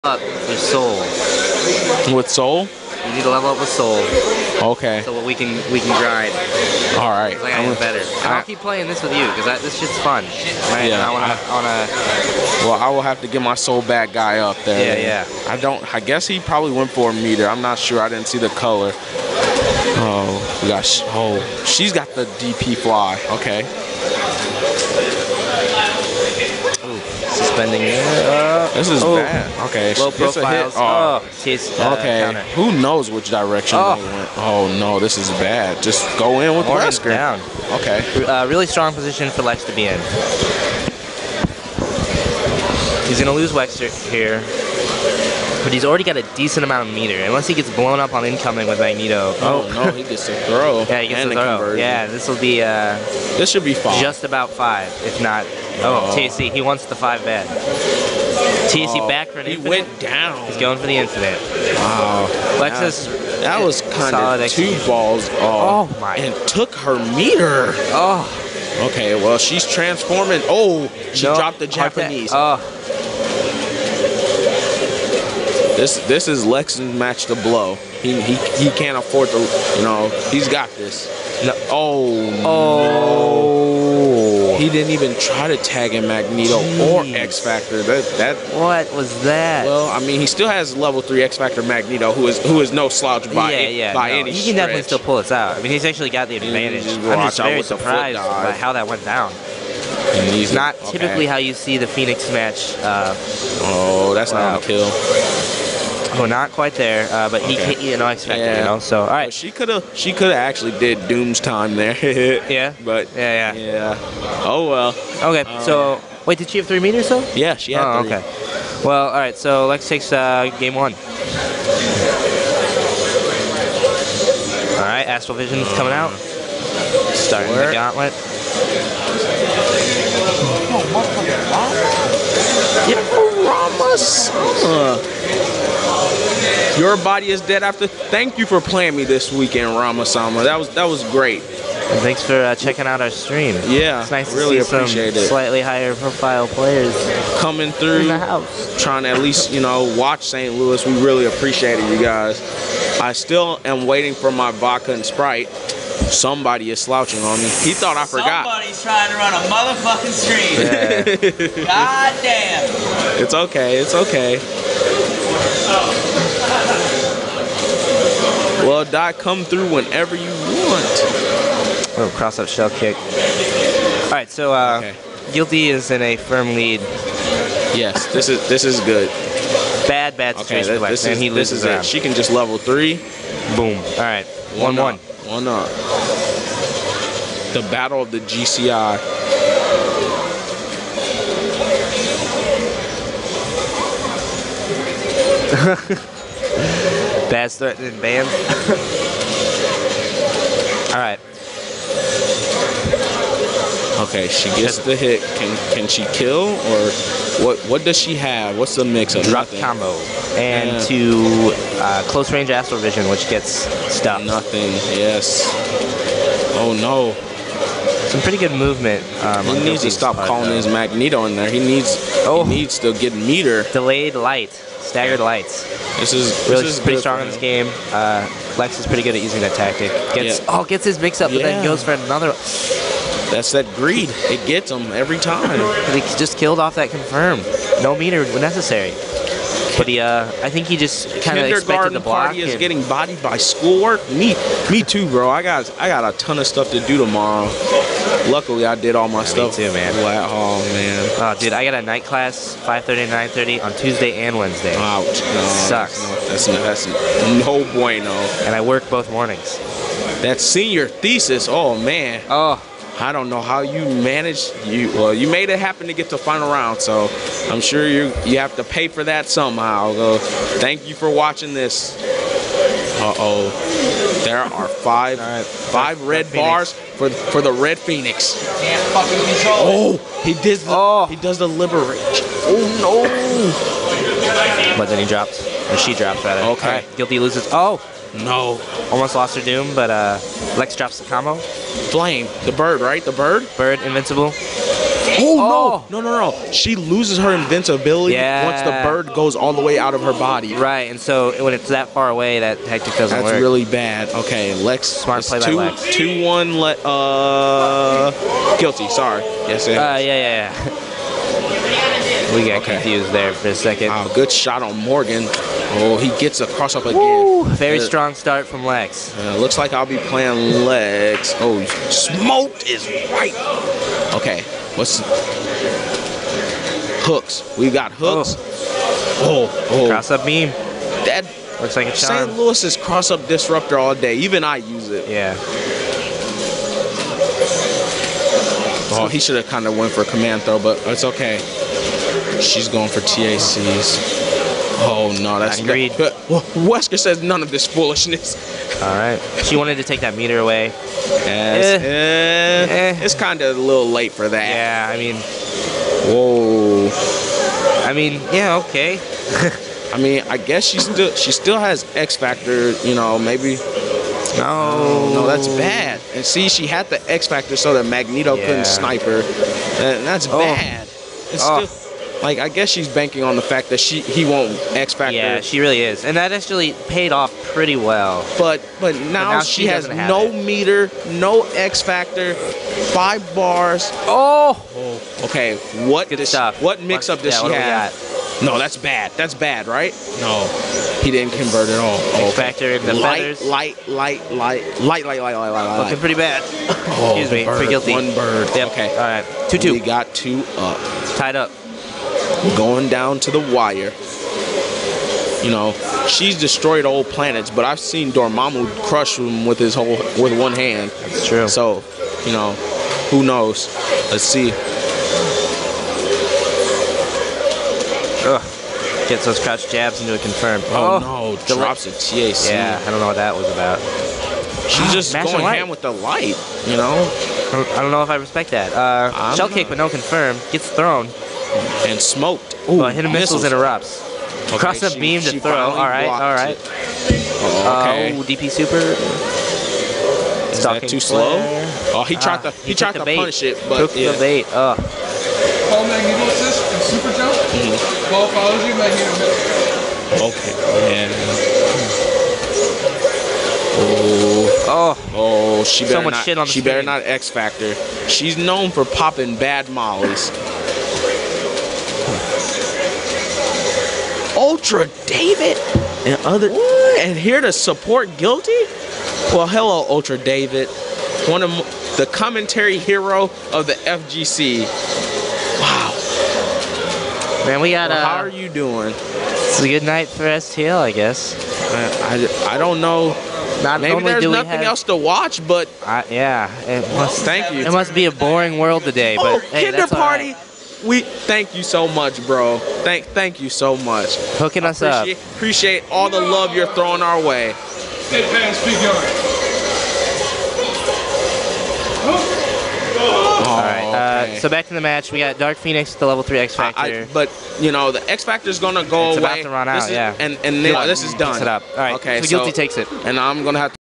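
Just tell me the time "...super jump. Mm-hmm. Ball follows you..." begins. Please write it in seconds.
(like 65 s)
446 s.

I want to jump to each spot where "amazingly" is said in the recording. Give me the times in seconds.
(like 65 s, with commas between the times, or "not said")
not said.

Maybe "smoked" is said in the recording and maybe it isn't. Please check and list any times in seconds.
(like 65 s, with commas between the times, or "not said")
321 s, 432 s.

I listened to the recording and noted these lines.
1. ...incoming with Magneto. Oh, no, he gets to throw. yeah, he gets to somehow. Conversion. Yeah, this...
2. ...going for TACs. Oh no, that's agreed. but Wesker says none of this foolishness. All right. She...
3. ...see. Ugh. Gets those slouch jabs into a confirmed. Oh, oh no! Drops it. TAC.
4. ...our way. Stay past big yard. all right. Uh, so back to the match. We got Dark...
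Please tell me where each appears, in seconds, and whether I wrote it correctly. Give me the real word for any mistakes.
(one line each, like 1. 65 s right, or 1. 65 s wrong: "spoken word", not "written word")
1. 48 s wrong: "throw", not "somehow"
2. 342 s right
3. 414 s wrong: "crouch", not "slouch"
4. 497 s right.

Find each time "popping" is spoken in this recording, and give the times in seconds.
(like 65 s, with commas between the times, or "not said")
458 s.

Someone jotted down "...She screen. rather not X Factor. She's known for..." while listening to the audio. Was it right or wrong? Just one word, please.
wrong.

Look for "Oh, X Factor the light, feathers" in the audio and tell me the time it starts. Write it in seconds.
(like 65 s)
392 s.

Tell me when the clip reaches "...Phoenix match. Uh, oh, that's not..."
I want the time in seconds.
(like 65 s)
101 s.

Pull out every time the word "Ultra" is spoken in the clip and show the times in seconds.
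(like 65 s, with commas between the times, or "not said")
464 s, 469 s.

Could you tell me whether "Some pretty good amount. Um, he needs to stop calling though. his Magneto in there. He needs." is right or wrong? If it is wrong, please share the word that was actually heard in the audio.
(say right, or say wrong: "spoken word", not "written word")
wrong: "movement", not "amount".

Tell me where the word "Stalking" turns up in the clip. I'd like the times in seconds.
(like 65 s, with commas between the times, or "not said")
440 s.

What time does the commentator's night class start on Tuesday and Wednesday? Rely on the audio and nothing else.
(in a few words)
5:30.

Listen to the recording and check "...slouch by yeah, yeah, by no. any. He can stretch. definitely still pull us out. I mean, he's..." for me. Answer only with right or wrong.
right.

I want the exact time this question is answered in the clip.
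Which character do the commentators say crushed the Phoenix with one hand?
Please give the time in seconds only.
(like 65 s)
408 s.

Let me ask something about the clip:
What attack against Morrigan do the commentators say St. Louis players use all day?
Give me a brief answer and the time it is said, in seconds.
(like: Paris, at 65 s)
Cross up disruptor, at 332 s.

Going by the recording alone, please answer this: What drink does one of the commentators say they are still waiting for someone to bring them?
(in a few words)
Vodka and Sprite.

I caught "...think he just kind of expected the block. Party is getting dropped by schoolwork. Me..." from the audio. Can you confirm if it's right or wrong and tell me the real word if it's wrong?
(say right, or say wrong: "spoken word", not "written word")
wrong: "bodied", not "dropped".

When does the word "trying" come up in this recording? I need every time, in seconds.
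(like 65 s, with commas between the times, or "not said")
148 s, 158 s.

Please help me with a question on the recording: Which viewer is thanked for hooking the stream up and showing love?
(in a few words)
Kinder Party.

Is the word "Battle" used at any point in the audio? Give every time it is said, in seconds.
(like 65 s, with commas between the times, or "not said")
187 s.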